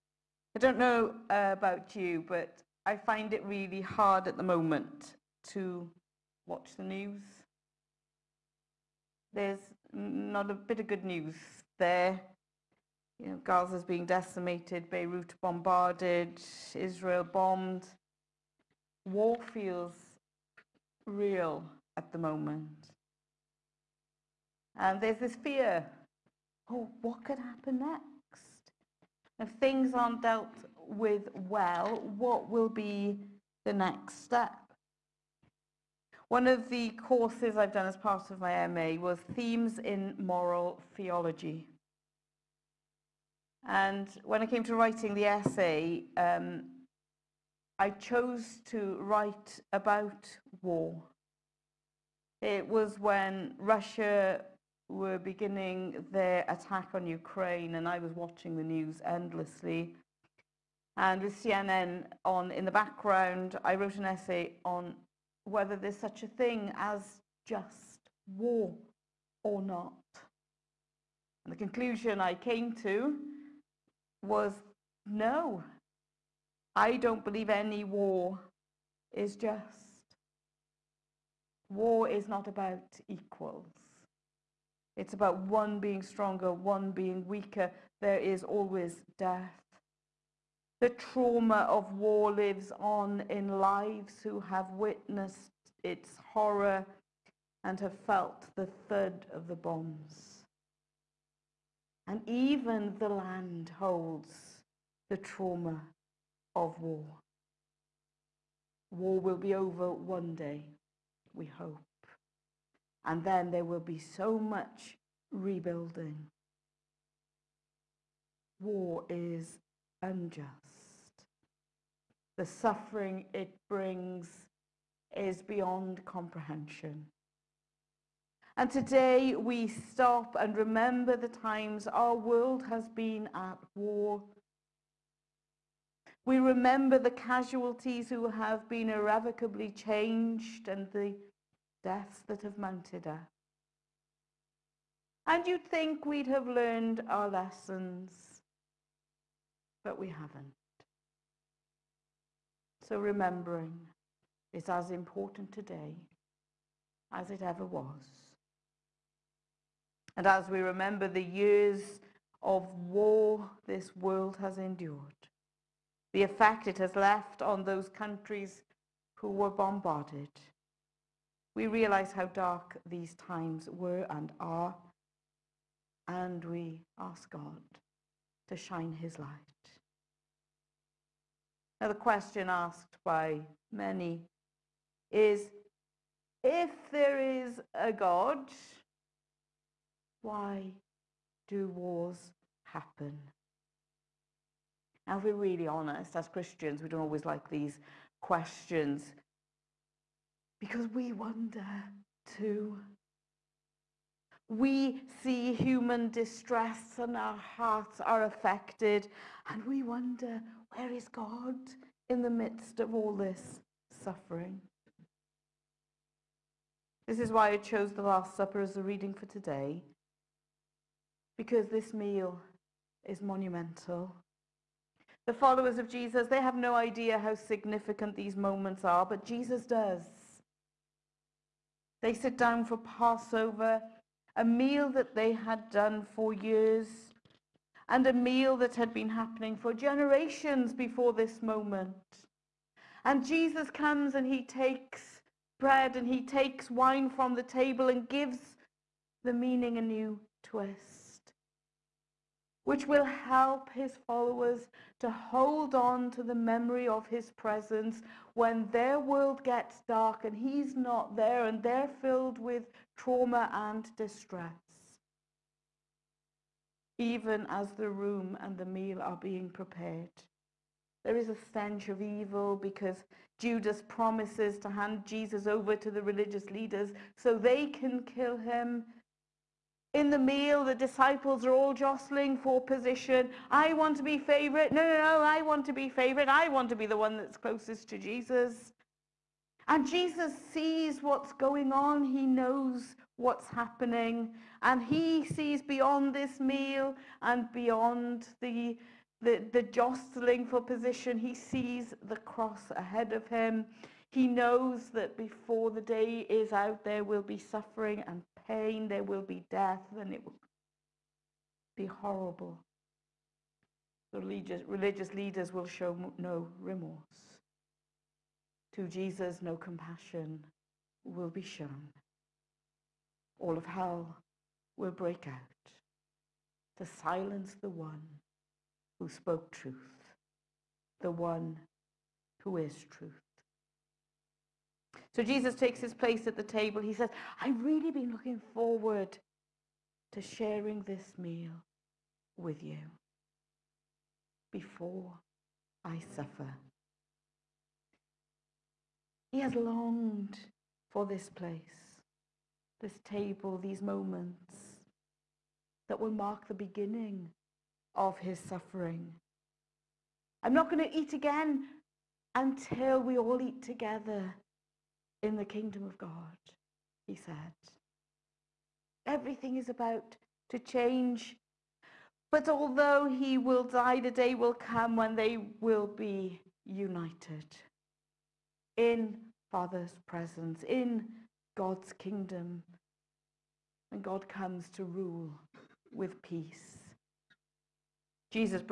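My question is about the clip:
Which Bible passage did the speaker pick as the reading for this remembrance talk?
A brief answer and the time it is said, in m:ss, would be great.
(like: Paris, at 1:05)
The Last Supper, at 3:37.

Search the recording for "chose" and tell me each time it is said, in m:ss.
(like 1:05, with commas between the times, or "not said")
0:47, 3:37.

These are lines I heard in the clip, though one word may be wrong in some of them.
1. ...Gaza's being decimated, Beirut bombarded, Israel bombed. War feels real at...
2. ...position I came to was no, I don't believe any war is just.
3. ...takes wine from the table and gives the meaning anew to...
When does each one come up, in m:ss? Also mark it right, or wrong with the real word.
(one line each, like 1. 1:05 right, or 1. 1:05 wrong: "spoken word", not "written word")
1. 0:13 right
2. 1:11 wrong: "conclusion", not "position"
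3. 4:06 right.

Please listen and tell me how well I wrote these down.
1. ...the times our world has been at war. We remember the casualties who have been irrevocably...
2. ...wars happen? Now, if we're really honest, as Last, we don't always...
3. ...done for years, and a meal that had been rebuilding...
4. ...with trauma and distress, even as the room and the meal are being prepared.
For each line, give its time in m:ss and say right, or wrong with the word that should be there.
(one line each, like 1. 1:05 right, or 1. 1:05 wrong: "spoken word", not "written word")
1. 2:11 right
2. 3:11 wrong: "Christians", not "Last"
3. 3:55 wrong: "happening", not "rebuilding"
4. 4:22 right.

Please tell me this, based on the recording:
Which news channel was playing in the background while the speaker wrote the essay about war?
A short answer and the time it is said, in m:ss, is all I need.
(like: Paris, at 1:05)
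CNN, at 1:01.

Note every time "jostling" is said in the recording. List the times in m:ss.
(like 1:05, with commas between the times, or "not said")
4:41, 4:59.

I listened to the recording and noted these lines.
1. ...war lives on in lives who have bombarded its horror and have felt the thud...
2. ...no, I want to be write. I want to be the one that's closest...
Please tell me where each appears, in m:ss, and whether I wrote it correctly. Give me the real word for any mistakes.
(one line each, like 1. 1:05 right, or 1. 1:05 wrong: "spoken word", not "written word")
1. 1:31 wrong: "witnessed", not "bombarded"
2. 4:44 wrong: "favorite", not "write".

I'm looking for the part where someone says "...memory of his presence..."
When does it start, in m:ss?
4:16.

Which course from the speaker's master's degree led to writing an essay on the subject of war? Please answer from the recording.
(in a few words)
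Themes in Moral Theology.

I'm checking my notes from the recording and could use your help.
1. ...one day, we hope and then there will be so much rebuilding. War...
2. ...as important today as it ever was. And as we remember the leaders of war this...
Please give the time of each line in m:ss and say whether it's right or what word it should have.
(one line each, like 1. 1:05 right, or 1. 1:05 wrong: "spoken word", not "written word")
1. 1:49 right
2. 2:34 wrong: "years", not "leaders".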